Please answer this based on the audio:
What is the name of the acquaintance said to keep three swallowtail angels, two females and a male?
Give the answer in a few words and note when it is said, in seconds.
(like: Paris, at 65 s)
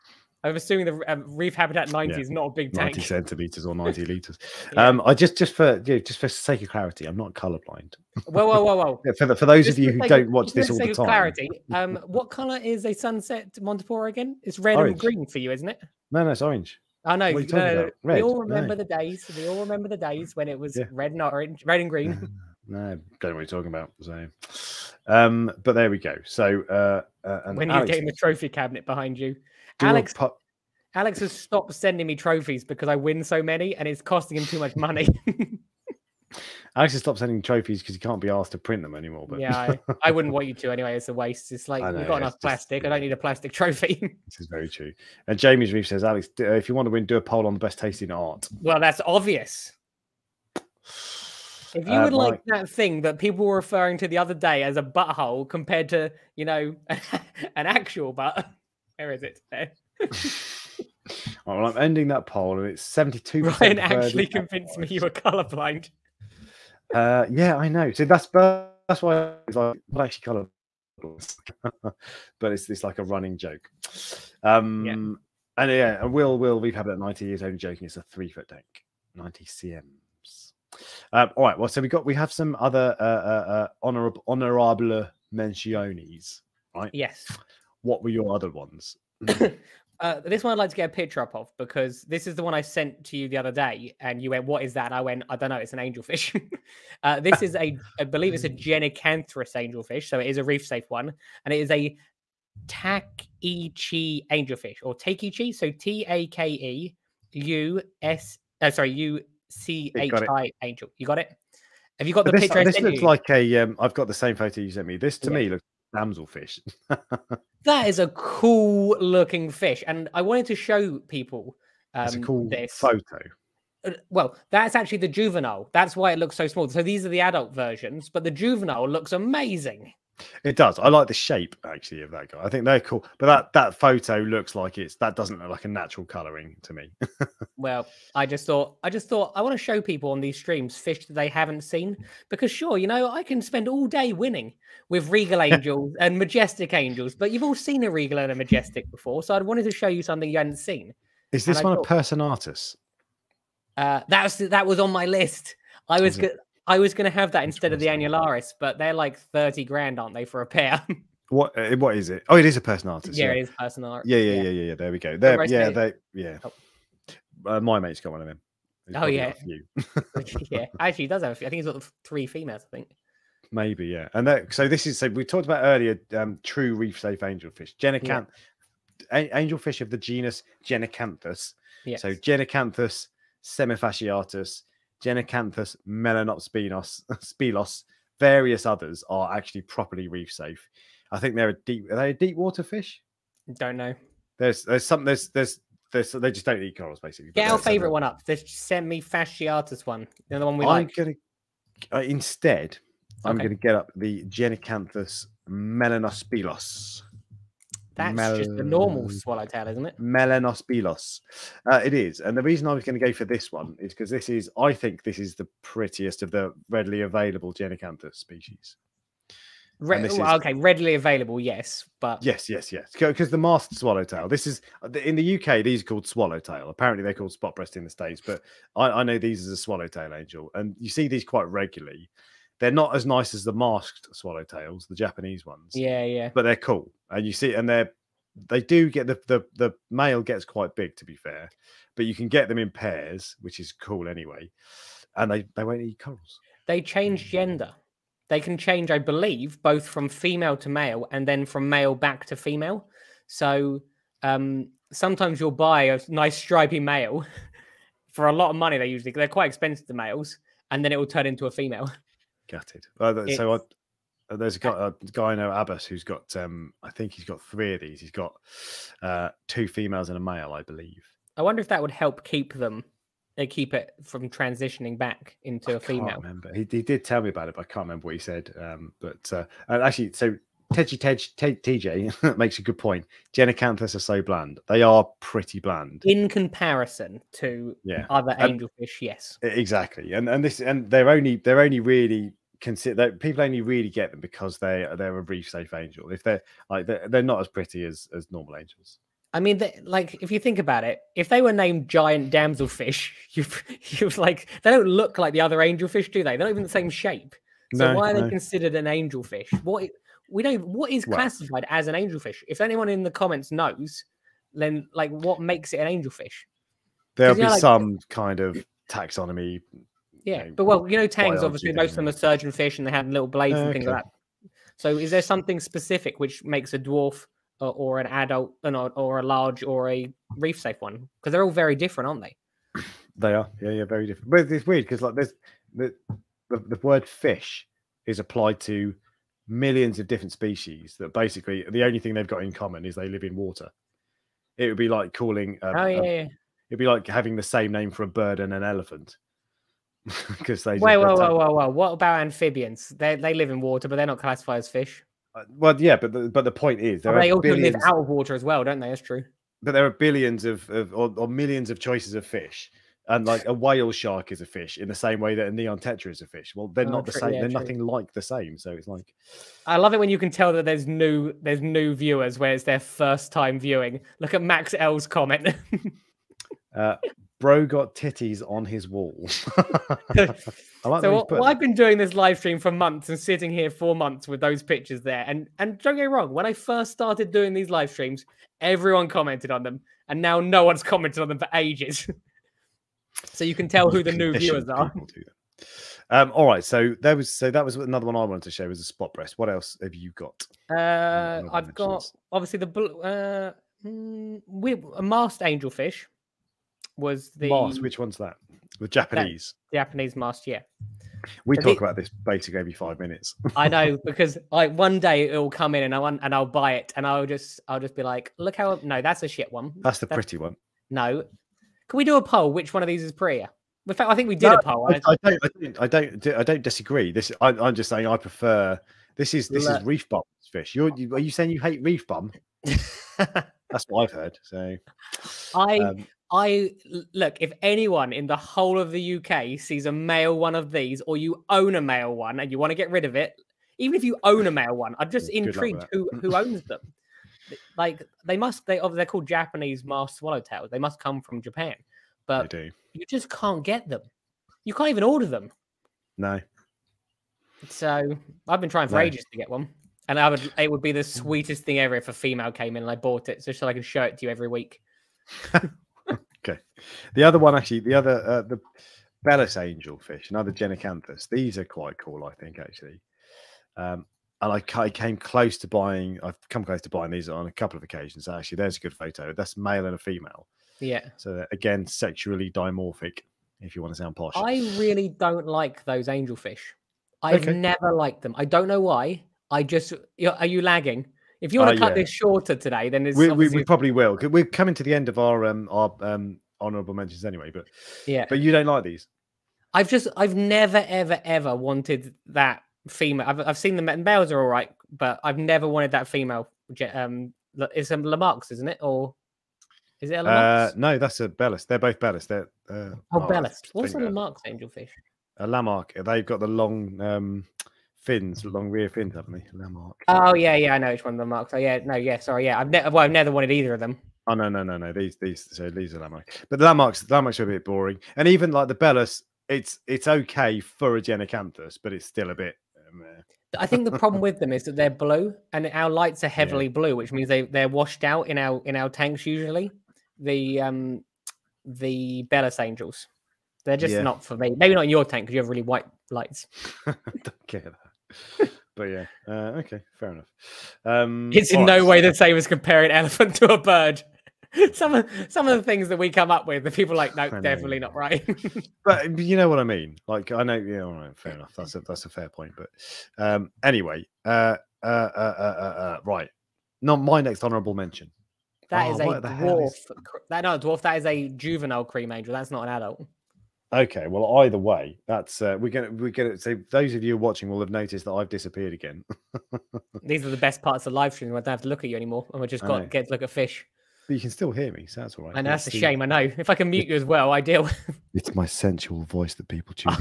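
Abbas, at 265 s.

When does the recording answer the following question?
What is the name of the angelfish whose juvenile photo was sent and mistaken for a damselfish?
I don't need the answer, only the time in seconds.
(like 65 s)
102 s.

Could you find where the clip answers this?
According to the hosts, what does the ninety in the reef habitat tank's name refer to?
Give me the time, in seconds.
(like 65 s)
79 s.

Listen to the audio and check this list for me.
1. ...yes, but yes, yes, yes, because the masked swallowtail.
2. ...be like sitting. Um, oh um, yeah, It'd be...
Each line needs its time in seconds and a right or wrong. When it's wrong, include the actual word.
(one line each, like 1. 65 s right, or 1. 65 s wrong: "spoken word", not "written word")
1. 221 s right
2. 344 s wrong: "calling", not "sitting".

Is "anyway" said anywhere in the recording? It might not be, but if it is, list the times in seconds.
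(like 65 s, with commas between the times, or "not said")
40 s, 244 s, 497 s, 563 s.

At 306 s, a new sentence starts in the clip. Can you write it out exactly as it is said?
They're not even the same shape.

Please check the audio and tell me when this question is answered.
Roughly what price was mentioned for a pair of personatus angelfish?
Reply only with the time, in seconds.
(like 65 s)
159 s.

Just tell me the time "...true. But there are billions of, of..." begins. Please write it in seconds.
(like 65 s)
359 s.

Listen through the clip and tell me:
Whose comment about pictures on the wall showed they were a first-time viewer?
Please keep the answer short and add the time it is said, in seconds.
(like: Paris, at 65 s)
Max L, at 374 s.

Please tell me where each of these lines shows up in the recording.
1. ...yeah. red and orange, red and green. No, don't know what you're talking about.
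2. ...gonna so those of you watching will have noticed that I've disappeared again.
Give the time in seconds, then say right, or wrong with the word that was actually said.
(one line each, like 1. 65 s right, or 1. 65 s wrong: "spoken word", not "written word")
1. 20 s right
2. 576 s right.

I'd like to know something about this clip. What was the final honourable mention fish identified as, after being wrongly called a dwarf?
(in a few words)
juvenile cream angel.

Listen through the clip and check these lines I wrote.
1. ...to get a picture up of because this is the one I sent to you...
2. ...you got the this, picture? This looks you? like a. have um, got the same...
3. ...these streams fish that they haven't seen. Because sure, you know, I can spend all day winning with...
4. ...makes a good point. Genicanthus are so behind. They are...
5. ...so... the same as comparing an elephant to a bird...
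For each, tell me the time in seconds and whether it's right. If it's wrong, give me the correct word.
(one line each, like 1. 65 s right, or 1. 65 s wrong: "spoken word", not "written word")
1. 90 s right
2. 112 s right
3. 140 s right
4. 282 s wrong: "bland", not "behind"
5. 552 s right.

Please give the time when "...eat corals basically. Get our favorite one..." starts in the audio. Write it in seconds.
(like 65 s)
196 s.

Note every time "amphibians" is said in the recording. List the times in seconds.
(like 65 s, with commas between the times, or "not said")
352 s.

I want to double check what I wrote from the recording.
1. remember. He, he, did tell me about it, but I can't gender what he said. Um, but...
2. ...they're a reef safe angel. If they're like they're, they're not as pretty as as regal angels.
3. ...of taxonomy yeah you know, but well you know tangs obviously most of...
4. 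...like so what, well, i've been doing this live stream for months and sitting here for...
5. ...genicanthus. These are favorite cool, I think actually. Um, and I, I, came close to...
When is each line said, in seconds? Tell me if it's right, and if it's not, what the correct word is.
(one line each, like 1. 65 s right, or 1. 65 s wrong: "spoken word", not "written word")
1. 276 s wrong: "remember", not "gender"
2. 294 s wrong: "normal", not "regal"
3. 318 s right
4. 380 s right
5. 470 s wrong: "quite", not "favorite".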